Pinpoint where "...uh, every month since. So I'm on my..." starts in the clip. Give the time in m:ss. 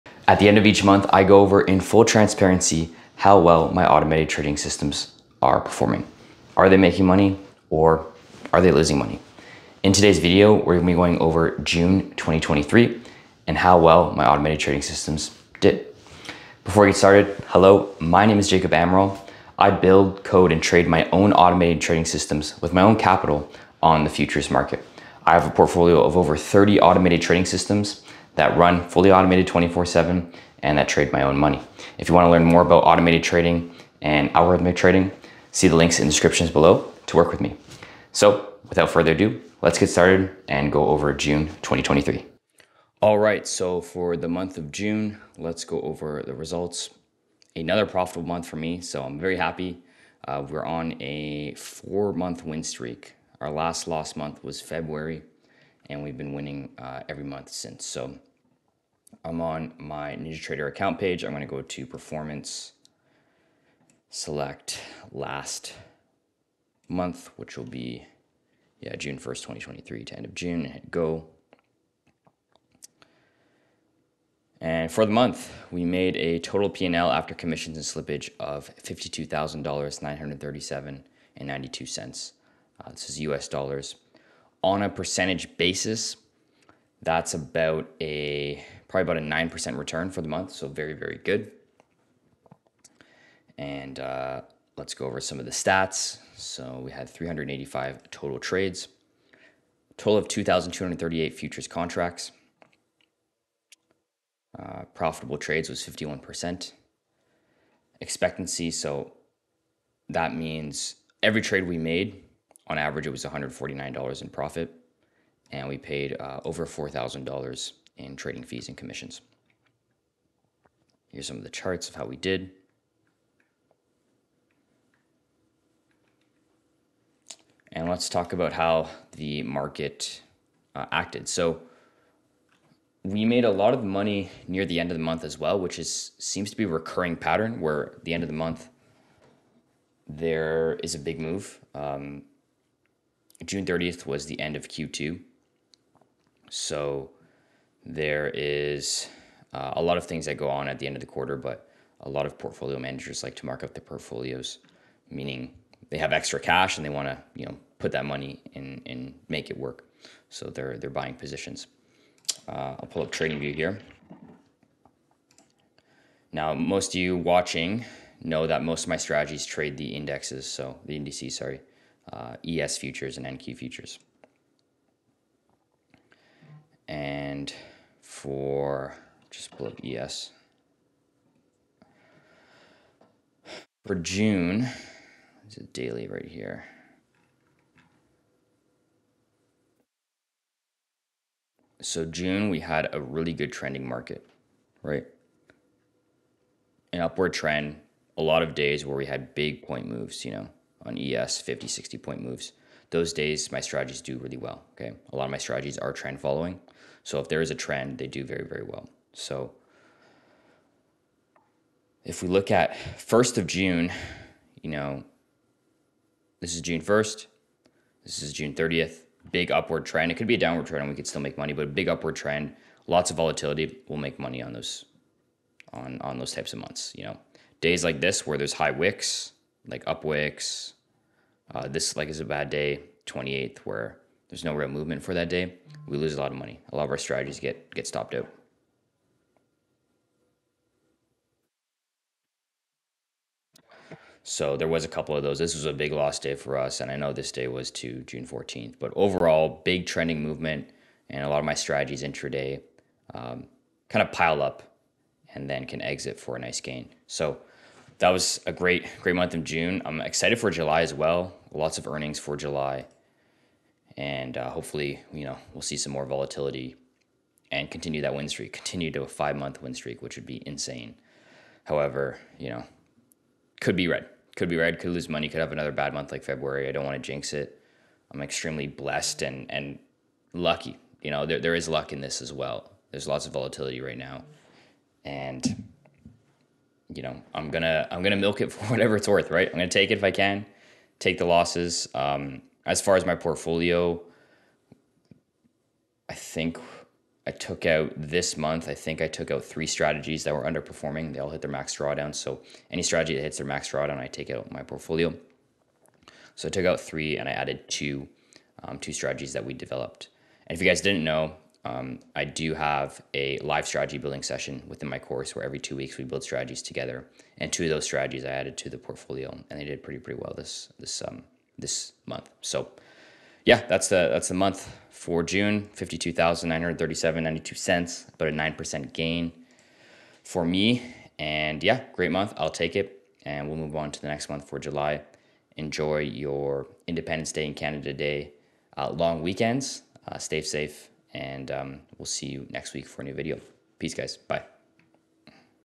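0:56.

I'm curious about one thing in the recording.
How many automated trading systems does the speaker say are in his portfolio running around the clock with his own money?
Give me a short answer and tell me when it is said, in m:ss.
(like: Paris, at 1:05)
over 30, at 0:26.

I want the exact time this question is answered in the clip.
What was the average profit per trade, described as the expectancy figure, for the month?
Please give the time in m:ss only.
1:53.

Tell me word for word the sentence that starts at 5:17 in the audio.
And two of those strategies I added to the portfolio, and they did pretty pretty well this this um, this month.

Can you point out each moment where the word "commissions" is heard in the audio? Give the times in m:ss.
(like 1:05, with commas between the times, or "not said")
1:17, 1:58.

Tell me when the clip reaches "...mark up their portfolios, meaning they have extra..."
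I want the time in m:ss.
2:33.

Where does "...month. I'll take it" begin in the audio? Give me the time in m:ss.
5:32.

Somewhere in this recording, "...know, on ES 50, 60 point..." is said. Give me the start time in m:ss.
3:20.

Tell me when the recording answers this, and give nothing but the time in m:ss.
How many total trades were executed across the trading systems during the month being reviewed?
1:37.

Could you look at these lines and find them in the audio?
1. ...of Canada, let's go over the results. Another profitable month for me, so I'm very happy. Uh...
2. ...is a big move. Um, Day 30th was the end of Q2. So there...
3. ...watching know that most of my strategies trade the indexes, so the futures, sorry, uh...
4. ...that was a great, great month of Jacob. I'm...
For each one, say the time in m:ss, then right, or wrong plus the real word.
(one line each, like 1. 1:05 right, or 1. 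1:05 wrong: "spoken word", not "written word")
1. 0:44 wrong: "June", not "Canada"
2. 2:20 wrong: "June", not "Day"
3. 2:47 wrong: "indices", not "futures"
4. 4:18 wrong: "June", not "Jacob".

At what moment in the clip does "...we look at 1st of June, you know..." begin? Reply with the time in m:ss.
3:32.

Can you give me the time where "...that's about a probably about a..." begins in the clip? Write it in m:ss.
1:27.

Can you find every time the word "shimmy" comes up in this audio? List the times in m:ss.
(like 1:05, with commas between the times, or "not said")
not said.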